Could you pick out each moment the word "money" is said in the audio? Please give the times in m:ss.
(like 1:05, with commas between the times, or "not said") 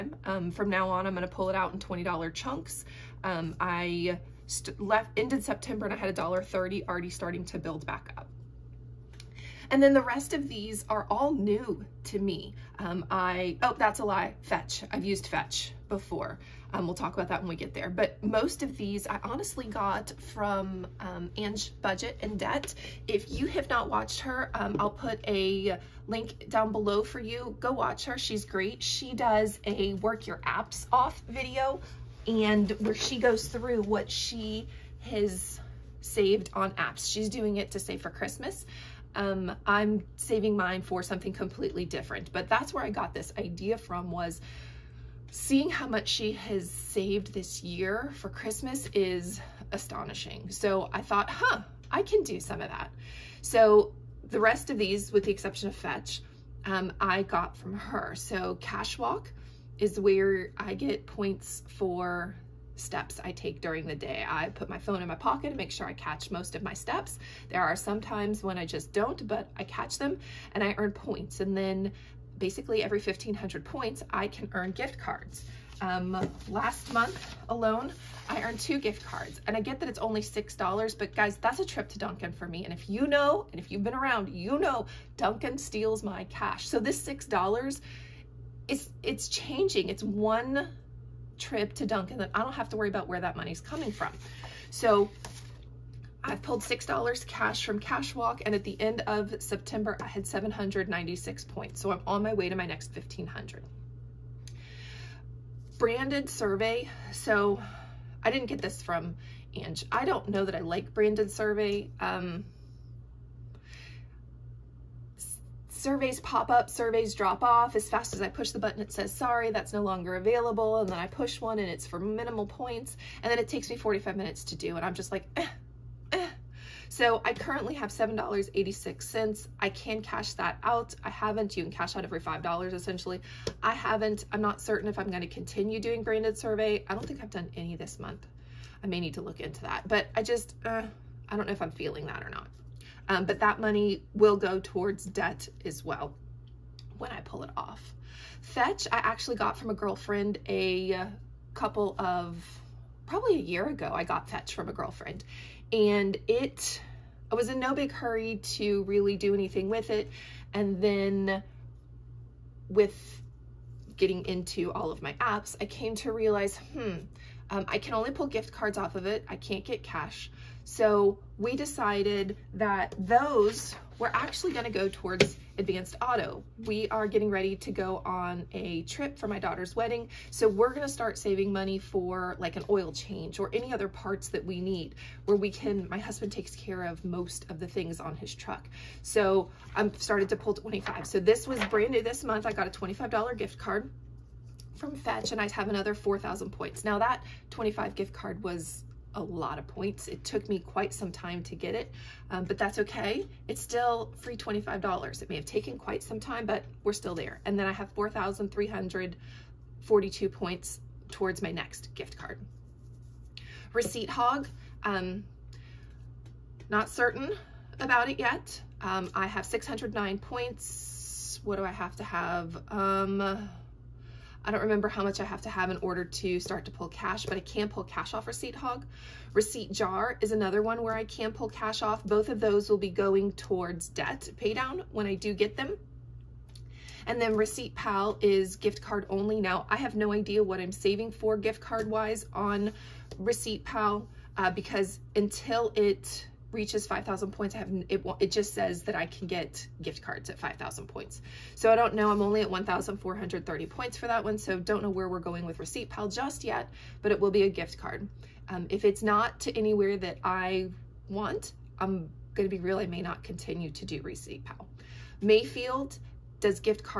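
1:33, 2:23, 3:01.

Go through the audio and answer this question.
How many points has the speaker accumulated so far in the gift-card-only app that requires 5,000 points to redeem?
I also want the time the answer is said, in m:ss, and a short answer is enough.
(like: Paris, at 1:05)
1,430, at 4:12.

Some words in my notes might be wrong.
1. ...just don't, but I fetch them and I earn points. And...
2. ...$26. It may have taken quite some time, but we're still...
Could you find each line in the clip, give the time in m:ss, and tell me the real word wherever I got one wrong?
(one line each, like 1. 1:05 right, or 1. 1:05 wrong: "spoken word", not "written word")
1. 1:08 wrong: "catch", not "fetch"
2. 3:24 wrong: "25", not "26".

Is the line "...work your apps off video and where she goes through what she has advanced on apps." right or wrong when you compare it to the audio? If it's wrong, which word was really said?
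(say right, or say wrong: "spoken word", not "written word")
wrong: "saved", not "advanced".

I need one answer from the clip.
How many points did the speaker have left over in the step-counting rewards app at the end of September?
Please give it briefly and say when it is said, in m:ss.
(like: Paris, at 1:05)
796, at 1:40.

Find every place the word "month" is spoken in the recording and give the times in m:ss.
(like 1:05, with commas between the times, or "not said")
1:16, 2:17, 3:12.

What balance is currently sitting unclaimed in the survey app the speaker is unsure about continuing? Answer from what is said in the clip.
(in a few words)
$7.86.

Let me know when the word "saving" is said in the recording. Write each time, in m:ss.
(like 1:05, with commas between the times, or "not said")
0:40, 3:01, 4:00.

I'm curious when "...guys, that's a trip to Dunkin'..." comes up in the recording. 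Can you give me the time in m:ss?
1:21.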